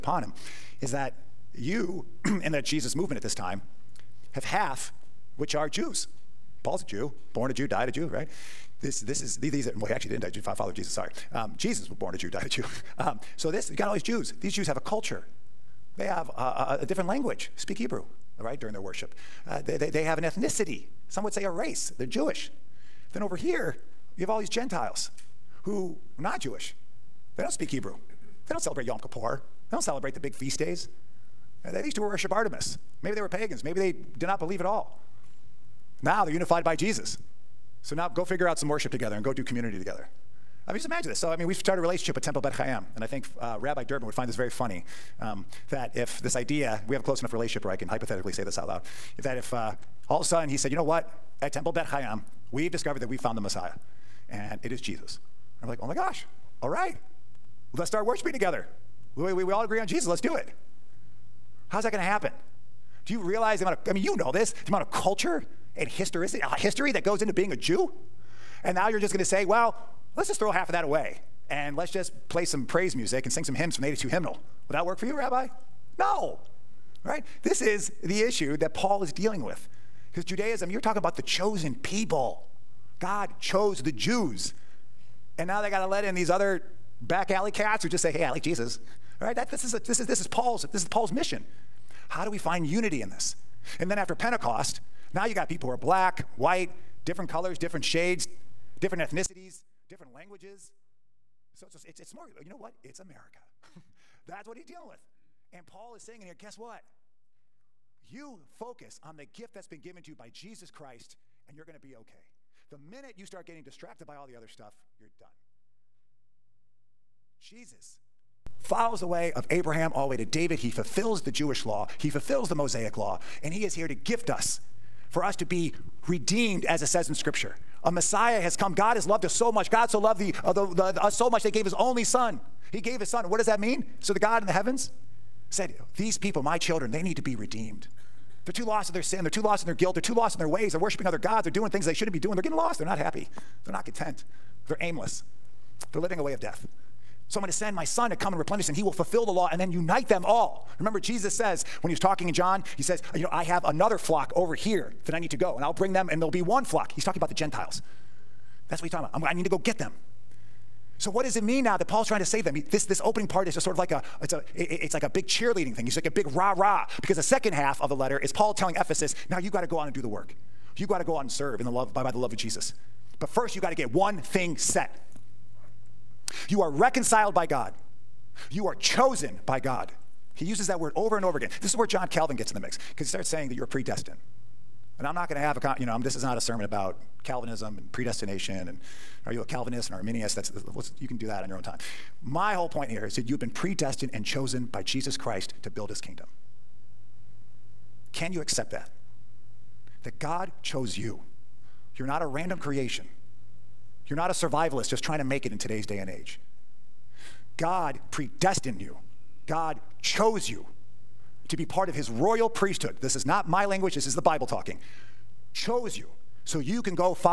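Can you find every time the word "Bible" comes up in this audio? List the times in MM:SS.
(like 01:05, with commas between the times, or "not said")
03:34.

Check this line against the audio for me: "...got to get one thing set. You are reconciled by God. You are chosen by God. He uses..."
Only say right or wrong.
right.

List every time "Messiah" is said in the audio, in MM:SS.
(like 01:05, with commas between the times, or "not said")
00:53, 02:07.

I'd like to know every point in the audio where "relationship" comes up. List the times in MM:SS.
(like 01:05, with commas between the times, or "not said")
00:41, 00:47.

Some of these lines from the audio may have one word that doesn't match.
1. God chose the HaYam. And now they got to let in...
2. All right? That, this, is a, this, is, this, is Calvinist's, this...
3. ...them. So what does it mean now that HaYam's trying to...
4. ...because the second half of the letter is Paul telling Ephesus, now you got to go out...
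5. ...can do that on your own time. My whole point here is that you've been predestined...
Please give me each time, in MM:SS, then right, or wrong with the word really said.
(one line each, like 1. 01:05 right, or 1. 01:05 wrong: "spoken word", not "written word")
1. 01:22 wrong: "Jews", not "HaYam"
2. 01:29 wrong: "Paul", not "Calvinist"
3. 02:39 wrong: "Paul", not "HaYam"
4. 02:47 right
5. 03:11 right.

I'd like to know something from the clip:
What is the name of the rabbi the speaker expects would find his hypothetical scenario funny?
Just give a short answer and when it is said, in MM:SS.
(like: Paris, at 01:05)
Rabbi Durbin, at 00:43.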